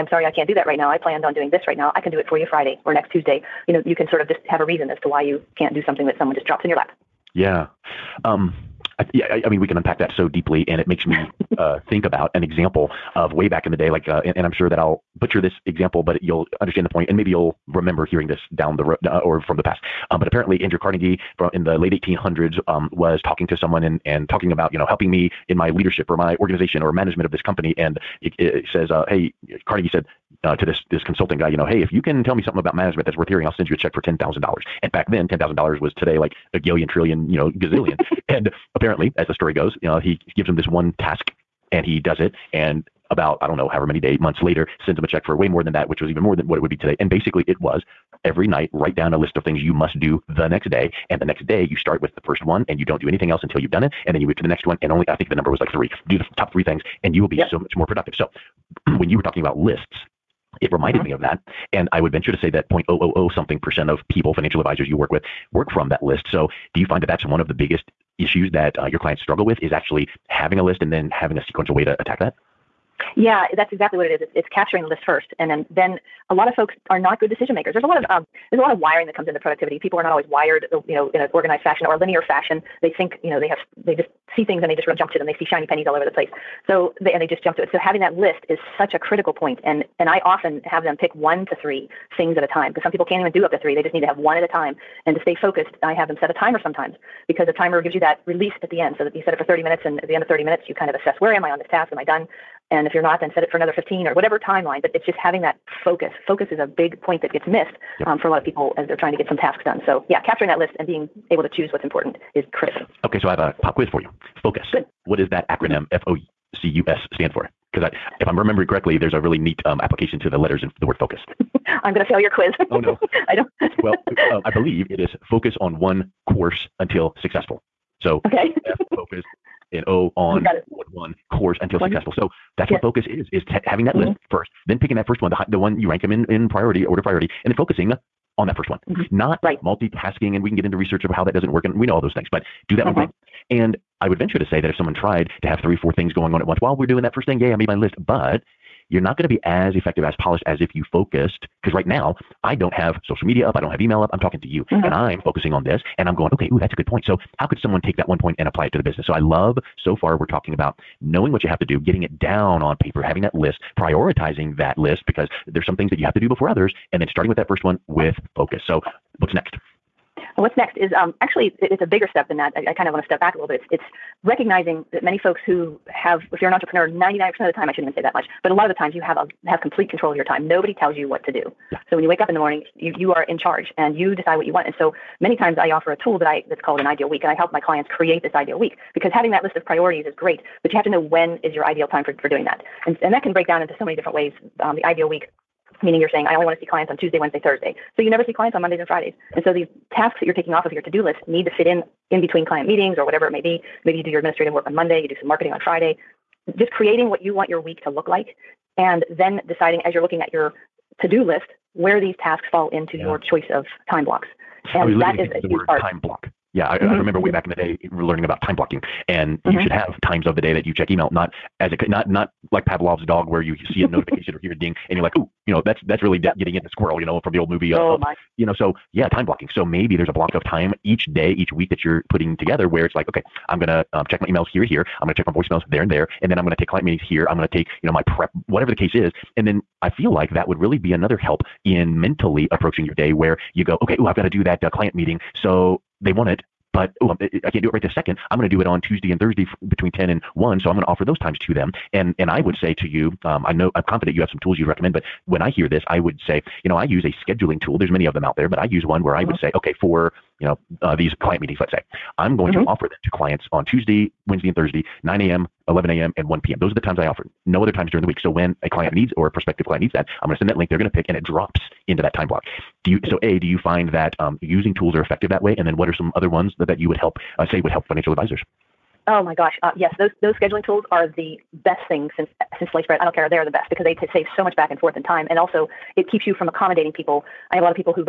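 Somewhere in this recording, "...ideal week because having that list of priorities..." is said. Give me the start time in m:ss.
3:08.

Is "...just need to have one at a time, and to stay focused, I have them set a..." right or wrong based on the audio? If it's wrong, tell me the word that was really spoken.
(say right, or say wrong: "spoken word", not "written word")
right.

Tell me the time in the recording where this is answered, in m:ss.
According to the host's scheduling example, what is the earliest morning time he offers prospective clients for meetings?
4:25.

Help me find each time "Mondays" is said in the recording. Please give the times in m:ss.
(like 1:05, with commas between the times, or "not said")
3:18, 3:24.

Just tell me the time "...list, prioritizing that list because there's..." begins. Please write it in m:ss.
2:43.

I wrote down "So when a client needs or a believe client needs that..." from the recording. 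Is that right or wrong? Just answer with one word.
wrong.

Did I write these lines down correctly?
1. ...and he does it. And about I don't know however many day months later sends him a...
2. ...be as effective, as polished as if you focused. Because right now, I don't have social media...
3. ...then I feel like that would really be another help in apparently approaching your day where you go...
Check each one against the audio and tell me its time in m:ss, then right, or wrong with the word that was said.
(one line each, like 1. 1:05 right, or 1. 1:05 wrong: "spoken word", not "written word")
1. 0:41 right
2. 2:29 right
3. 3:59 wrong: "mentally", not "apparently".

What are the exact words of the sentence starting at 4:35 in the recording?
And then what are some other ones that, that you would help uh, say would help financial advisors?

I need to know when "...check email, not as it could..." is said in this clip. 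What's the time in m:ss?
3:40.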